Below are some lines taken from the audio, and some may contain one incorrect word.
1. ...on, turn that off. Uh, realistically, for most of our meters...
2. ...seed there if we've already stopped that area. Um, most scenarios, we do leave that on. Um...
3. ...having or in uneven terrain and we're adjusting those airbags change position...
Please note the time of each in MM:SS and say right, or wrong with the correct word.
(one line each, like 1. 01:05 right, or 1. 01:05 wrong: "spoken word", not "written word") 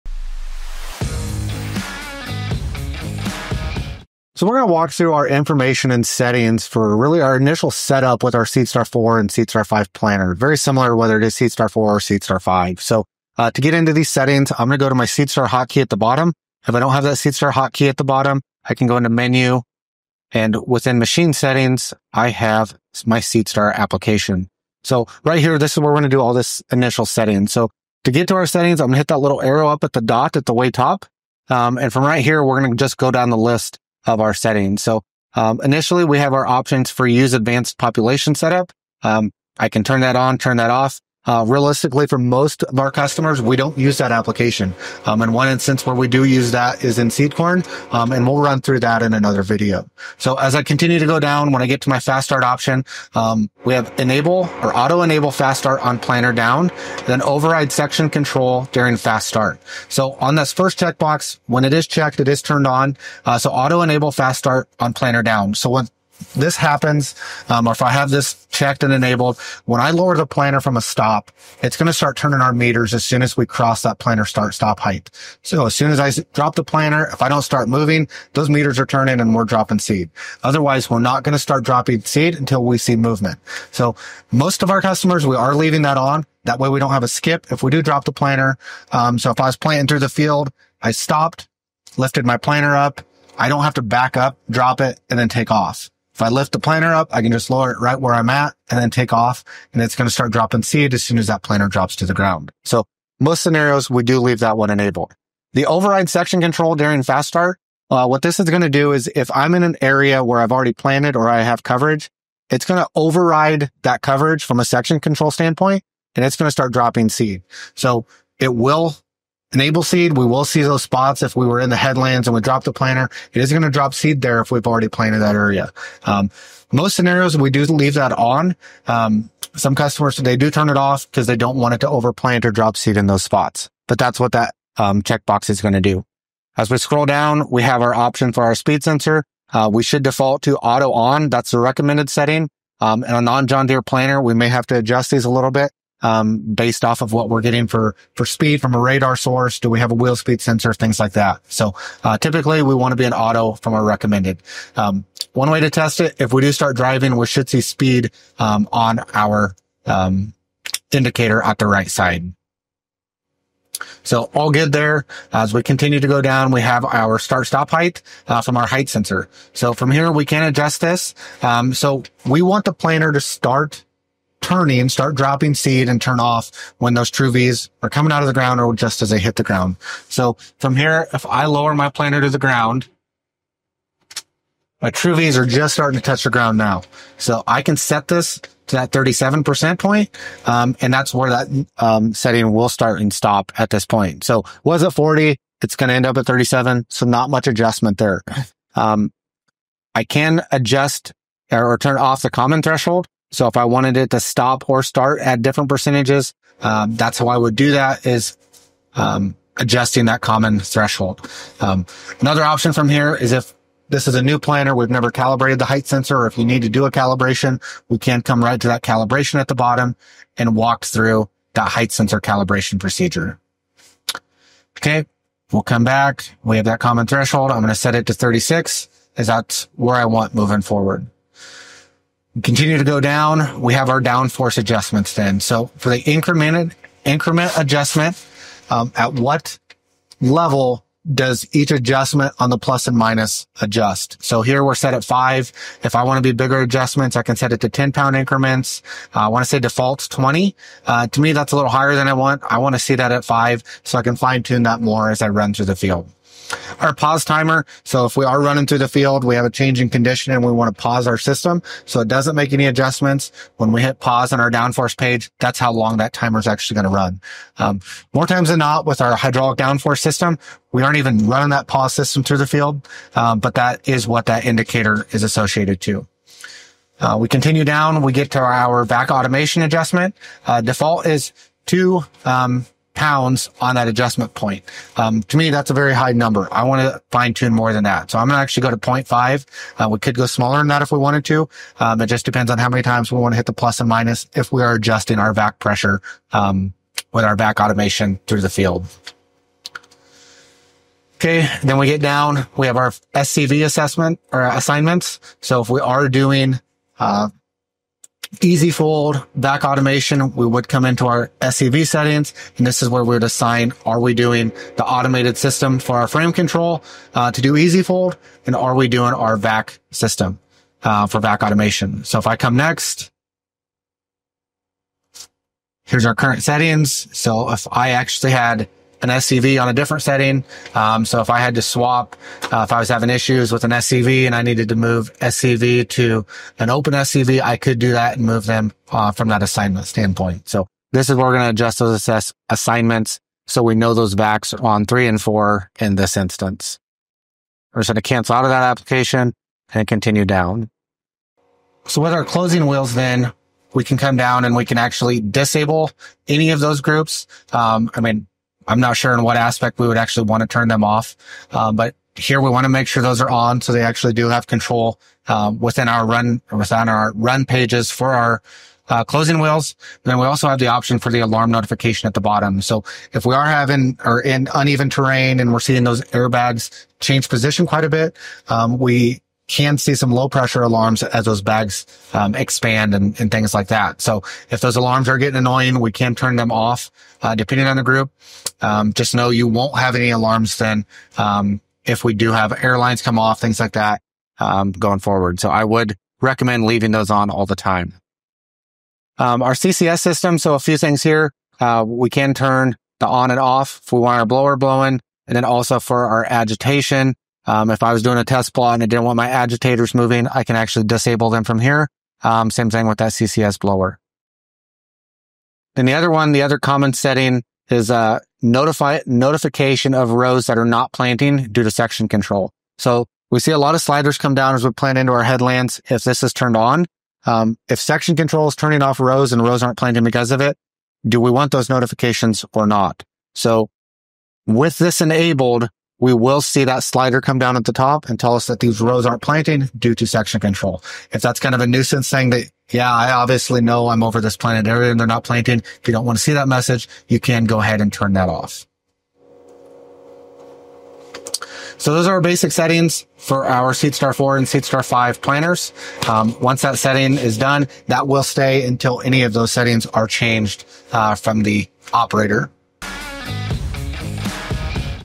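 1. 00:40 wrong: "customers", not "meters"
2. 02:03 wrong: "planted", not "stopped"
3. 06:13 wrong: "seeing", not "adjusting".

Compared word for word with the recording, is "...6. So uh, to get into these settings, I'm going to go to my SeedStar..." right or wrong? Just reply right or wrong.
wrong.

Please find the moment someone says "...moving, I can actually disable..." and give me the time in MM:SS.
06:49.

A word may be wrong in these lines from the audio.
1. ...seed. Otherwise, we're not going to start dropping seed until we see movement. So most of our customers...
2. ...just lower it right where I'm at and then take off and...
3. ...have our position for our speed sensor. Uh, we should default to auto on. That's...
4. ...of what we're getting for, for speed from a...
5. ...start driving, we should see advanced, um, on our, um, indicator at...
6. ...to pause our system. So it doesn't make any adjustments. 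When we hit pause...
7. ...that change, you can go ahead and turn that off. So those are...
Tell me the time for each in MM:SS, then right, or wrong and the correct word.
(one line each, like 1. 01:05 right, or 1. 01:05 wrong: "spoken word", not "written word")
1. 01:19 right
2. 01:37 right
3. 02:17 wrong: "option", not "position"
4. 02:27 right
5. 02:36 wrong: "speed", not "advanced"
6. 04:20 right
7. 07:26 wrong: "message", not "change".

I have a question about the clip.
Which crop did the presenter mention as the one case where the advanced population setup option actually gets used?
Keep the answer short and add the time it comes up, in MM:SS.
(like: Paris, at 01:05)
Seed corn, at 00:47.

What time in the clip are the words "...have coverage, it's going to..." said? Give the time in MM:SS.
01:51.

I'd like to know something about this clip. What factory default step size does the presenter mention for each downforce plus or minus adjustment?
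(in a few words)
20.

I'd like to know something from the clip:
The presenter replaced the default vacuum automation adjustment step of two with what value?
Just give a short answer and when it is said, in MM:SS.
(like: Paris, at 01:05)
0.5, at 04:48.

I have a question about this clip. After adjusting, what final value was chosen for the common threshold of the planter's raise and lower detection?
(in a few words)
36.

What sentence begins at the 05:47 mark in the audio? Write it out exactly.
We're just going to cancel out of that application and continue down.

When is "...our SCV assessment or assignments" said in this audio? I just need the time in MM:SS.
05:02.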